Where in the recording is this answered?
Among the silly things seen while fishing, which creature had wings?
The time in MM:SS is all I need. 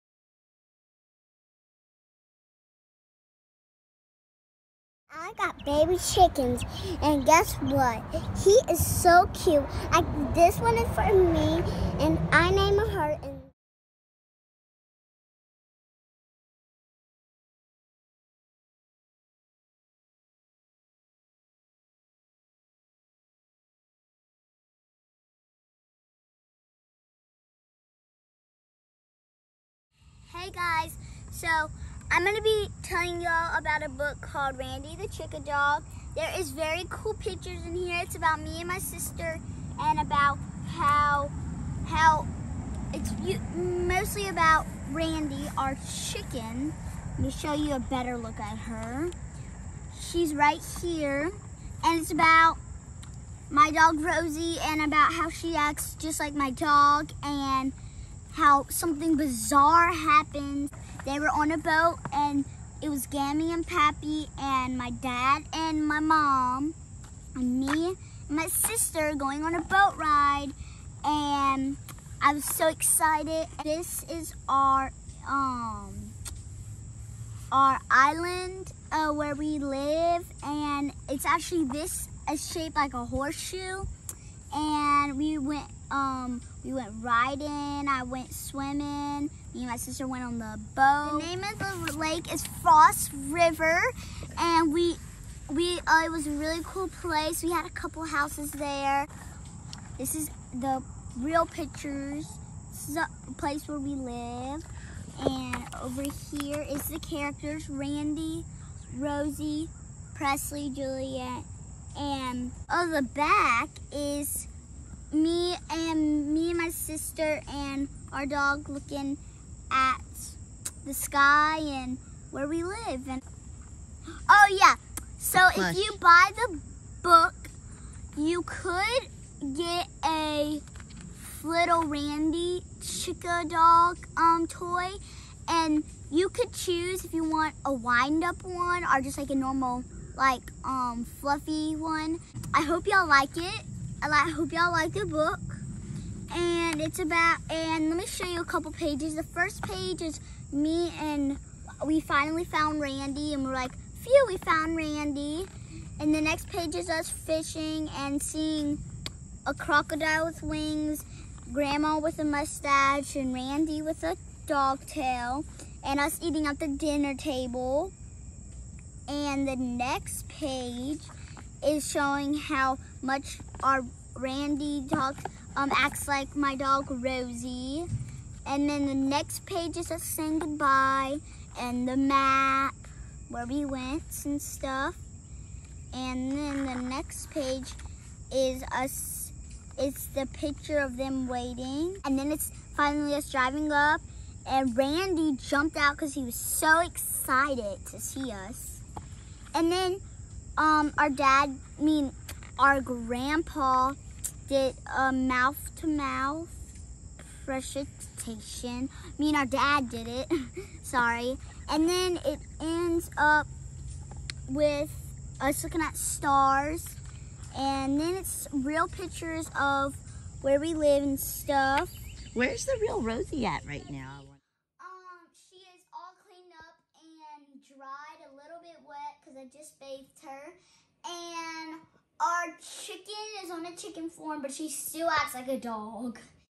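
02:39.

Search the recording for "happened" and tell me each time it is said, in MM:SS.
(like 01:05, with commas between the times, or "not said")
00:59.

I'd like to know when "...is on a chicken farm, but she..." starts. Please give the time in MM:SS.
03:53.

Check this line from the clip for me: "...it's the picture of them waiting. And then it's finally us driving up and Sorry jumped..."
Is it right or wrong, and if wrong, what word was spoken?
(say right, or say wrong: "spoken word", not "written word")
wrong: "Randi", not "Sorry".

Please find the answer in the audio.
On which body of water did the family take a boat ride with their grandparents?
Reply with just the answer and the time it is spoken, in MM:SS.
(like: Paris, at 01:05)
False River, at 01:32.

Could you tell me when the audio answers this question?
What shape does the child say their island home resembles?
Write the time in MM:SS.
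01:23.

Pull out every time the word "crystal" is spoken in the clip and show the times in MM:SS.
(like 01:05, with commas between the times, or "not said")
not said.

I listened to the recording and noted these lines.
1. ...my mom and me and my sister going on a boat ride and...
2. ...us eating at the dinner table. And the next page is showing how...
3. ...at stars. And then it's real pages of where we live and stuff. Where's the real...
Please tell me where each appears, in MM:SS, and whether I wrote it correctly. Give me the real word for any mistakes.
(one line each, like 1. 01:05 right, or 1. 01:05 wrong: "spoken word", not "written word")
1. 01:05 right
2. 02:45 right
3. 03:35 wrong: "pictures", not "pages".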